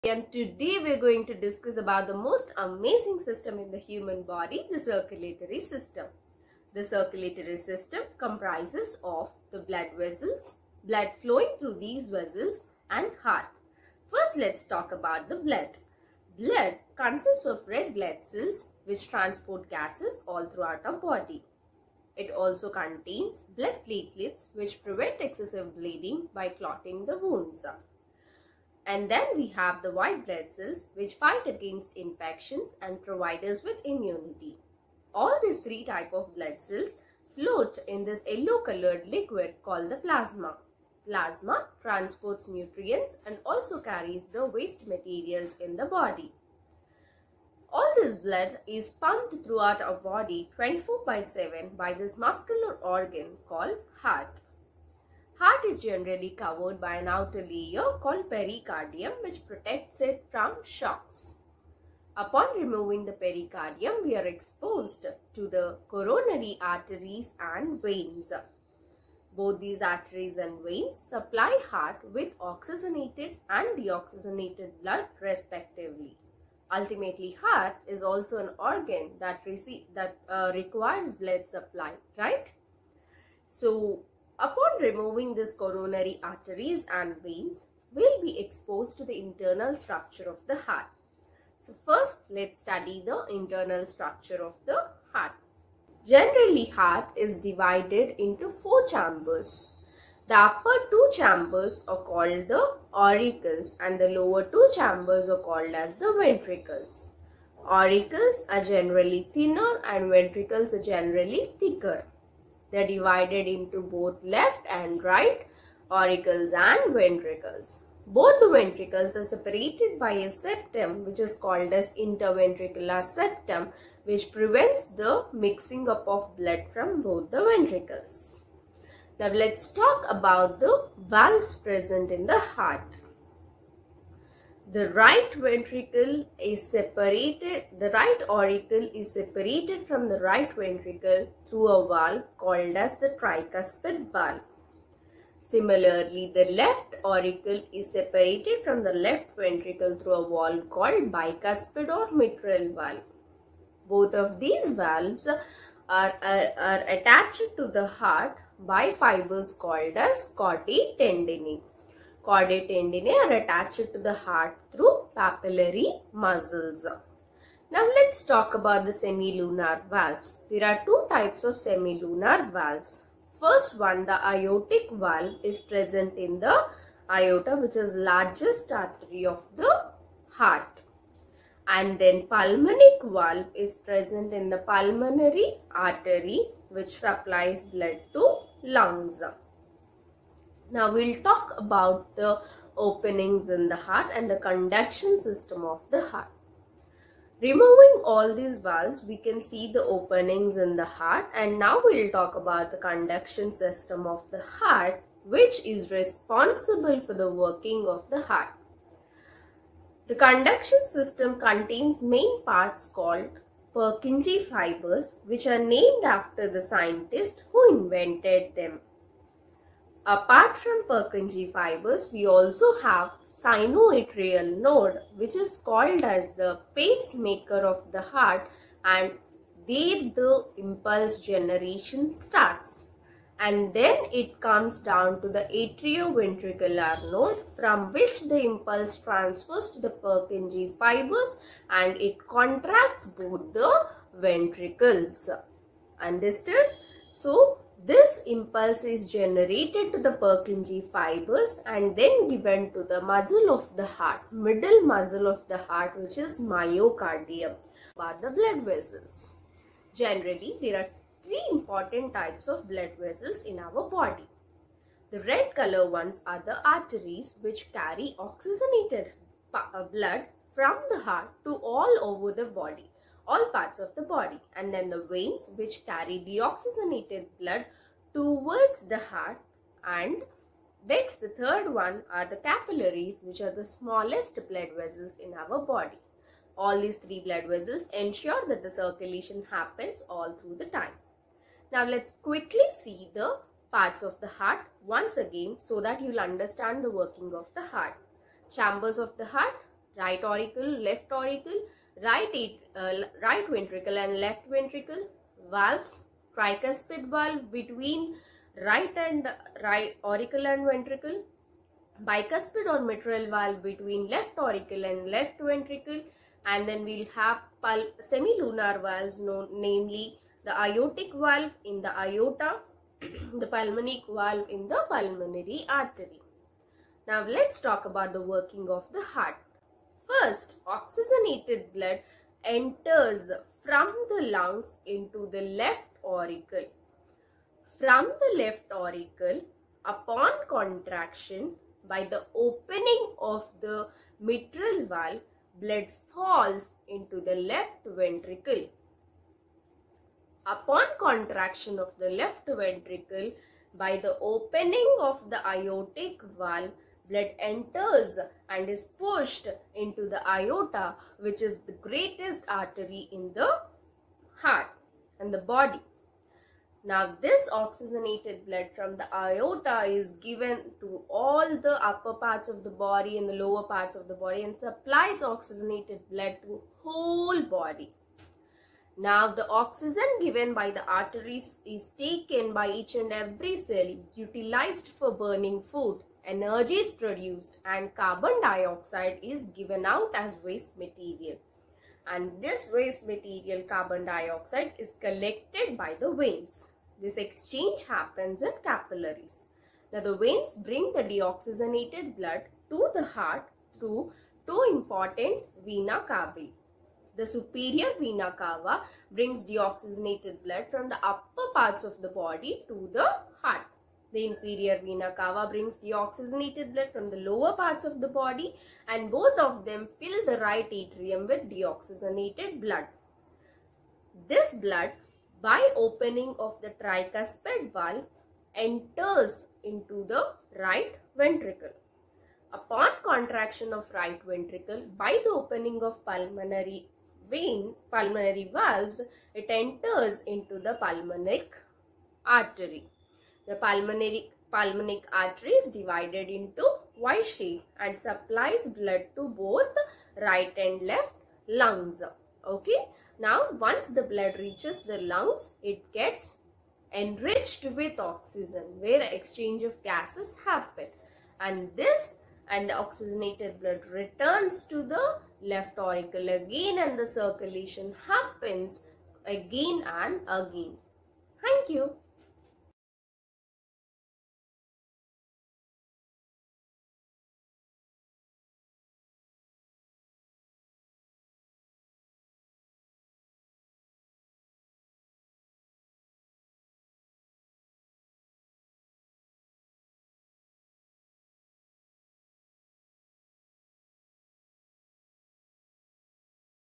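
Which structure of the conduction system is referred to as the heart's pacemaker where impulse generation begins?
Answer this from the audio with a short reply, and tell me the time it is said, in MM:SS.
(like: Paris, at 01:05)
Sinoatrial node, at 03:43.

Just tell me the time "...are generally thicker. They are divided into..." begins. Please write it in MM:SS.
01:50.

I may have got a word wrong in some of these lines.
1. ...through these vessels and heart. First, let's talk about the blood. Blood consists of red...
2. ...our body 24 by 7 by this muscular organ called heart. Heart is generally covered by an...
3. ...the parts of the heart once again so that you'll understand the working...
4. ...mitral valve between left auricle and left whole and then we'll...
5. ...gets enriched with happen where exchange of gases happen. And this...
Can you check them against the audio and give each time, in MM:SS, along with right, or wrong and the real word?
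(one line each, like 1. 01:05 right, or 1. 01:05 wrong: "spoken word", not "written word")
1. 00:11 right
2. 00:49 right
3. 04:53 right
4. 05:12 wrong: "ventricle", not "whole"
5. 07:35 wrong: "oxygen", not "happen".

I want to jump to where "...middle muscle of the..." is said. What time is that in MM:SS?
04:14.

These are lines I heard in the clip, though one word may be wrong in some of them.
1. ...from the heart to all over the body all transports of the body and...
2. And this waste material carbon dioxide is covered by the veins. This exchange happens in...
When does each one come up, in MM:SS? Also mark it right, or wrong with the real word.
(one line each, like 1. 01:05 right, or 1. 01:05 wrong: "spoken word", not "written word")
1. 04:30 wrong: "parts", not "transports"
2. 06:32 wrong: "collected", not "covered".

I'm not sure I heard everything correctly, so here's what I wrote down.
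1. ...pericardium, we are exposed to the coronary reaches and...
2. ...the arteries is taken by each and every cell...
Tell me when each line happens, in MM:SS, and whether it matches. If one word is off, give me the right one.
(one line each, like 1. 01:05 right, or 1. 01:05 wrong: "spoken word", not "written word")
1. 01:03 wrong: "arteries", not "reaches"
2. 06:20 right.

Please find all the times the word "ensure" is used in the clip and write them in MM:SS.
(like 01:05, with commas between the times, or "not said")
04:47.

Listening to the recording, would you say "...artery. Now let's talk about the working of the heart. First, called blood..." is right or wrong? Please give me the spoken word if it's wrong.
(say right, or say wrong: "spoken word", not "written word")
wrong: "oxygenated", not "called".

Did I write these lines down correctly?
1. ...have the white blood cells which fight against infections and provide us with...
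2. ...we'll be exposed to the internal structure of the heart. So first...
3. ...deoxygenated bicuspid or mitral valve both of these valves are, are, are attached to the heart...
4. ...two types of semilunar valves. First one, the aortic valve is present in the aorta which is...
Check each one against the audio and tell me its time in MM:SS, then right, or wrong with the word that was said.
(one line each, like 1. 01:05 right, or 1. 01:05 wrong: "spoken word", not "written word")
1. 00:29 right
2. 01:27 right
3. 02:30 wrong: "called", not "deoxygenated"
4. 02:50 right.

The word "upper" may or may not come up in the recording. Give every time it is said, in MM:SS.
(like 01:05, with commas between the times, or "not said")
01:40, 06:11, 06:51.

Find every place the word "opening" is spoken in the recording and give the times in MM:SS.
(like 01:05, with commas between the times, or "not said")
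03:12, 03:19, 05:42, 05:54, 07:05, 07:15.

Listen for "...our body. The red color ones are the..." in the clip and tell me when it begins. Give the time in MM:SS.
04:23.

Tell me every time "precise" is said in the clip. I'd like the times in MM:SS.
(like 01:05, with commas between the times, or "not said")
not said.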